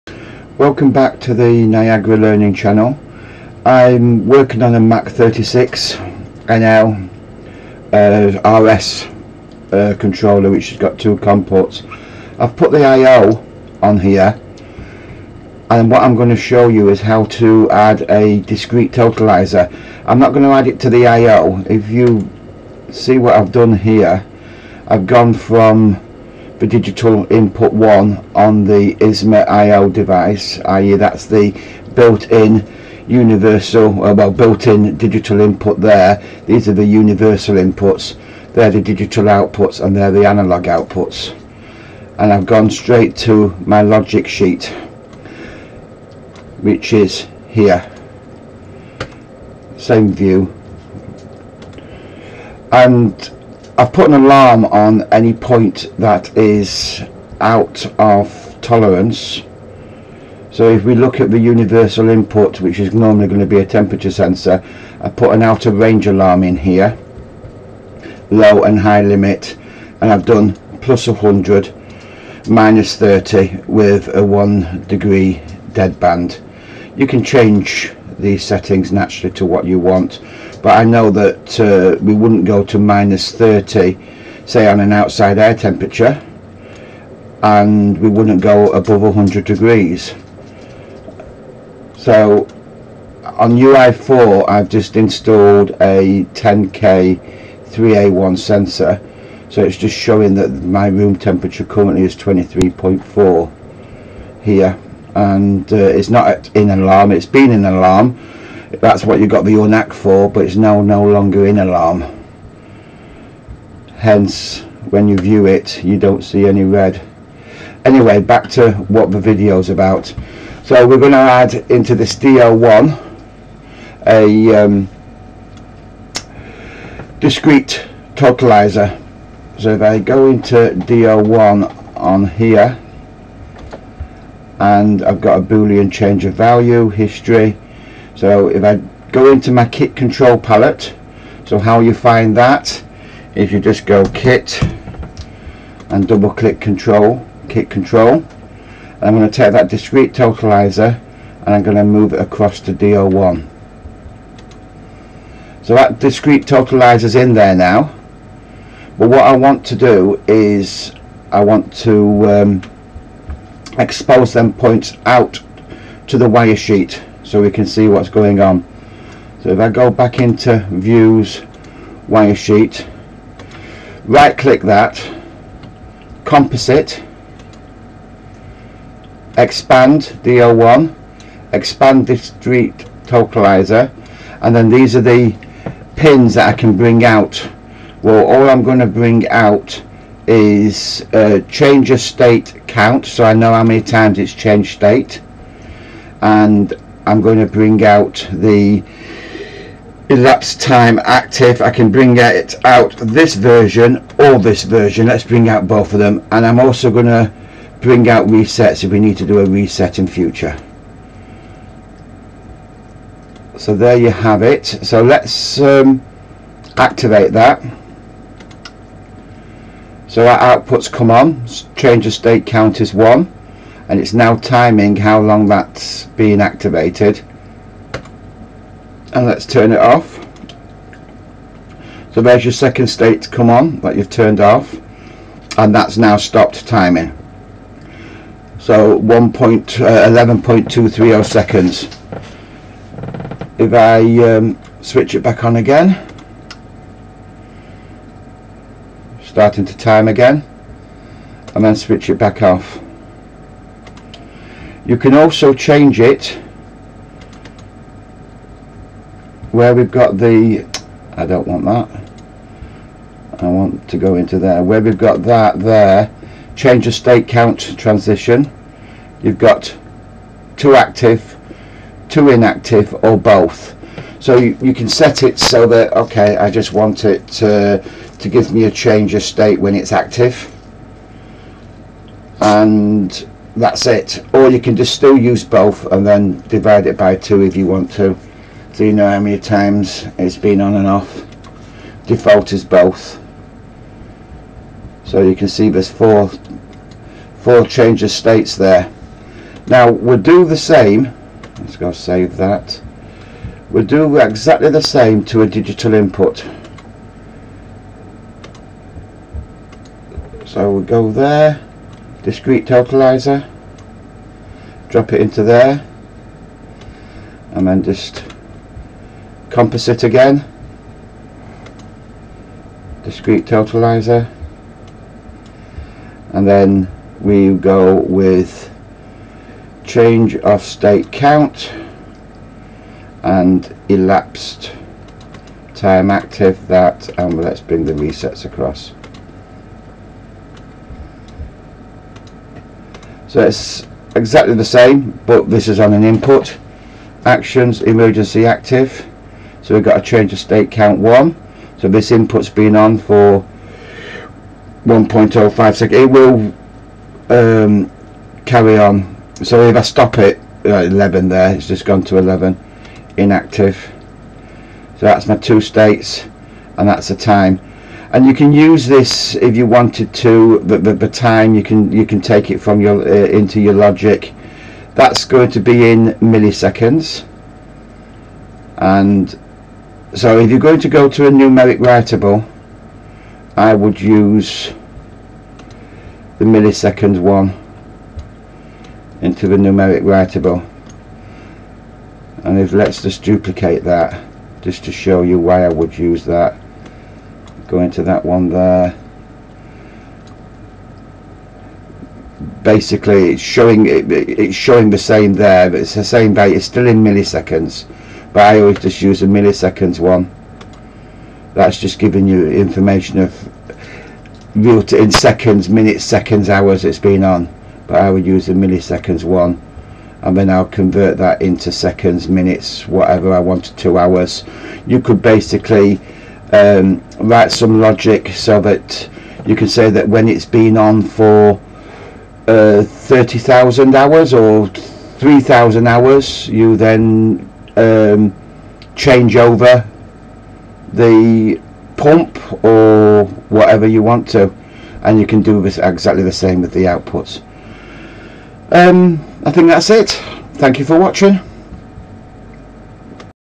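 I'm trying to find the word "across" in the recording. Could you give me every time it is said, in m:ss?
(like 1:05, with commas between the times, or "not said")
2:32, 5:38.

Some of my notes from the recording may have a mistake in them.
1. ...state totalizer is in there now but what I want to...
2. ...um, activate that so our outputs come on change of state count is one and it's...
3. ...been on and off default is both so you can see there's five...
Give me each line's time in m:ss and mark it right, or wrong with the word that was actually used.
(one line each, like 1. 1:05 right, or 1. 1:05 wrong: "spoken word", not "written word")
1. 2:35 wrong: "discrete", not "state"
2. 3:35 right
3. 4:50 wrong: "four", not "five".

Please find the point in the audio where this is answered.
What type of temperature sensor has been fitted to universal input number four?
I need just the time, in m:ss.
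1:36.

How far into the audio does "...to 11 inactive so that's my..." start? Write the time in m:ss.
6:02.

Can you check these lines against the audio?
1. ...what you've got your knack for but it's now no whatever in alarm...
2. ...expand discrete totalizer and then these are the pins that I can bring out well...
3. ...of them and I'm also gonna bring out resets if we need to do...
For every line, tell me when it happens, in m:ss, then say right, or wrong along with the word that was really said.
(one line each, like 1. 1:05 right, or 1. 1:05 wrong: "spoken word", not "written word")
1. 1:49 wrong: "longer", not "whatever"
2. 3:01 right
3. 3:25 right.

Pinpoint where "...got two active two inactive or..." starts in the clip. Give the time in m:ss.
4:29.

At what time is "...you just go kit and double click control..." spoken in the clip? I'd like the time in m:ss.
2:23.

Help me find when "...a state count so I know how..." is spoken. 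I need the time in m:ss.
3:11.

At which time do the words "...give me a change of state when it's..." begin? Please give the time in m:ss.
4:38.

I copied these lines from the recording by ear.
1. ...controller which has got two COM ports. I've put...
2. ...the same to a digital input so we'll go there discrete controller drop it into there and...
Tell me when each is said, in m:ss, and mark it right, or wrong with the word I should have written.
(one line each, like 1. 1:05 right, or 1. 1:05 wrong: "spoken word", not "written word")
1. 0:09 right
2. 5:04 wrong: "totalizer", not "controller".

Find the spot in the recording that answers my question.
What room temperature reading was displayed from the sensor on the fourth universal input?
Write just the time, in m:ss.
1:42.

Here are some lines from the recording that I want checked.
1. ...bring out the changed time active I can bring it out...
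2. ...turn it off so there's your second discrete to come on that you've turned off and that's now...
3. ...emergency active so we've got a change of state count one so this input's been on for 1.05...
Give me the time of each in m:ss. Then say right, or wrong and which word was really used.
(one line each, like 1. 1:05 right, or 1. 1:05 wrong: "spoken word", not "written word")
1. 3:17 wrong: "elapsed", not "changed"
2. 3:49 wrong: "state", not "discrete"
3. 5:47 right.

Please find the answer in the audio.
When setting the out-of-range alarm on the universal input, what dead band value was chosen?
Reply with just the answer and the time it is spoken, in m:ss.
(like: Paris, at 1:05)
1 degree, at 1:14.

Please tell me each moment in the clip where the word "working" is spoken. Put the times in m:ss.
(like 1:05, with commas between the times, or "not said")
0:04.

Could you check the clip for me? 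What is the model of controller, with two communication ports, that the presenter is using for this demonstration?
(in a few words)
Mac 36.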